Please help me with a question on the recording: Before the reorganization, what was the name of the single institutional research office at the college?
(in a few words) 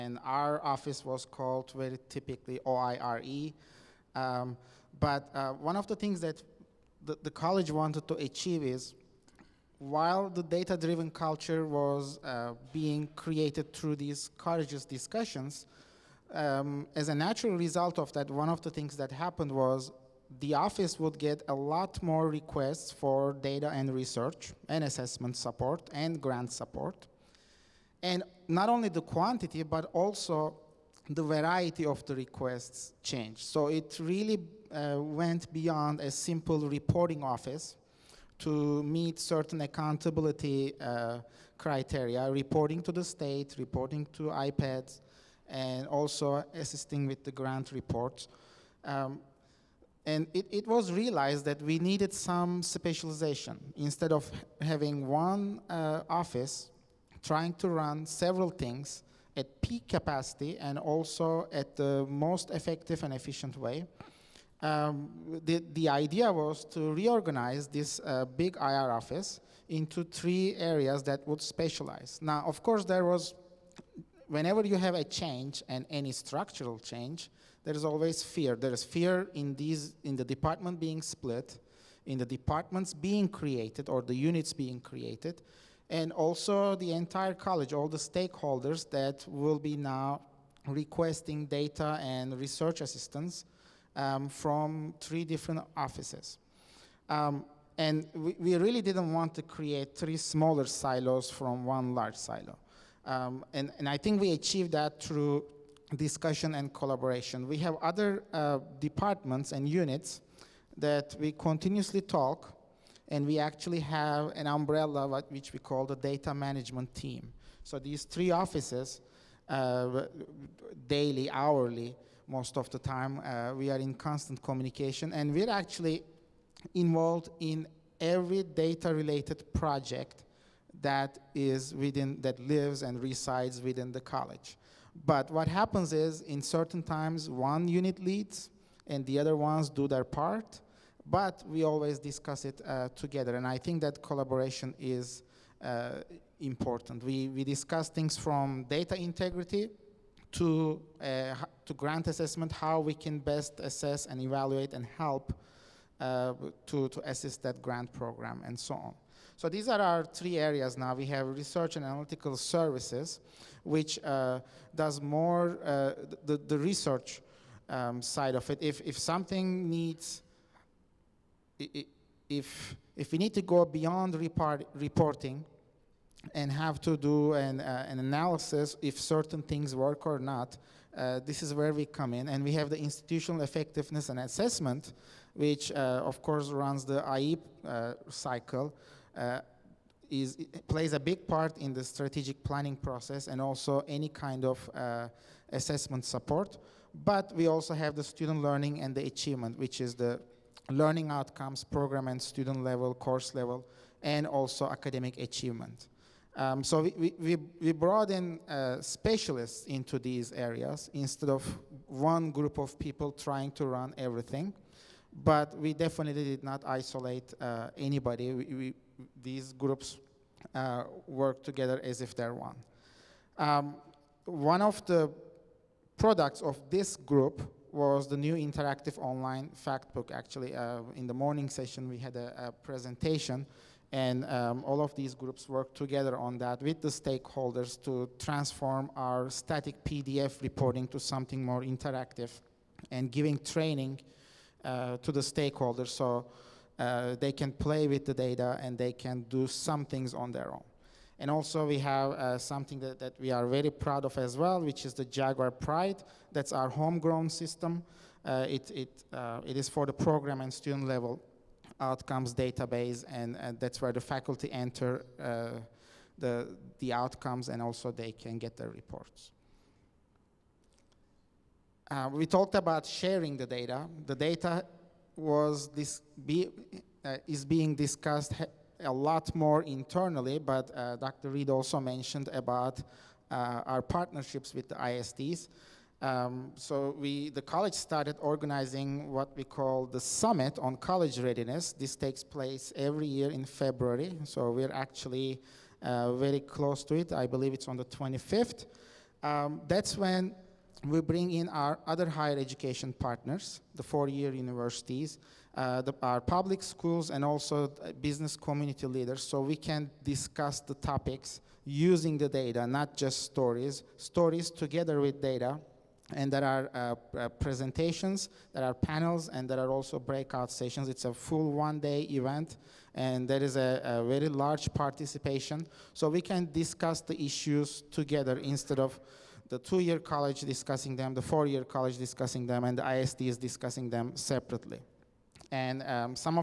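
OIRE.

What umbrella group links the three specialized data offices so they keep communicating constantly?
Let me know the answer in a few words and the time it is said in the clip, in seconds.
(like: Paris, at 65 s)
data management team, at 115 s.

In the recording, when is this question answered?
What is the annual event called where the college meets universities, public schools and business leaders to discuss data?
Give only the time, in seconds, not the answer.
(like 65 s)
290 s.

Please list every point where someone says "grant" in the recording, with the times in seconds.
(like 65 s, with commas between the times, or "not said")
26 s, 47 s, 151 s, 157 s.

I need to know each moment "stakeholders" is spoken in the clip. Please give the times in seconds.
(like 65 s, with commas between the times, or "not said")
87 s, 236 s, 245 s.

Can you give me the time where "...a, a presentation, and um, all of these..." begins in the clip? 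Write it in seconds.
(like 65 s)
232 s.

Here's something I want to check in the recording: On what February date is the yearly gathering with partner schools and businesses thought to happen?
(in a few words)
25th.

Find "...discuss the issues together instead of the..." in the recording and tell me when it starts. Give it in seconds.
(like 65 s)
326 s.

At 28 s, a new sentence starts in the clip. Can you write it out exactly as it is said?
And not only the quantity, but also the variety of the requests changed.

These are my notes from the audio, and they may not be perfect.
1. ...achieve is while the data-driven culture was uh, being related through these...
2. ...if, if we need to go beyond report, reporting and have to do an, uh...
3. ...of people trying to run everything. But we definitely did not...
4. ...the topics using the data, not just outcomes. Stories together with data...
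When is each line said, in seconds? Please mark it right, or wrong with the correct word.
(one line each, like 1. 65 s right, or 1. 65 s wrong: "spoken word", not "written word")
1. 8 s wrong: "created", not "related"
2. 172 s right
3. 212 s right
4. 310 s wrong: "stories", not "outcomes".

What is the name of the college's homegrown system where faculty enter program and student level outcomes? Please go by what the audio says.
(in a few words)
Jaguar Pride.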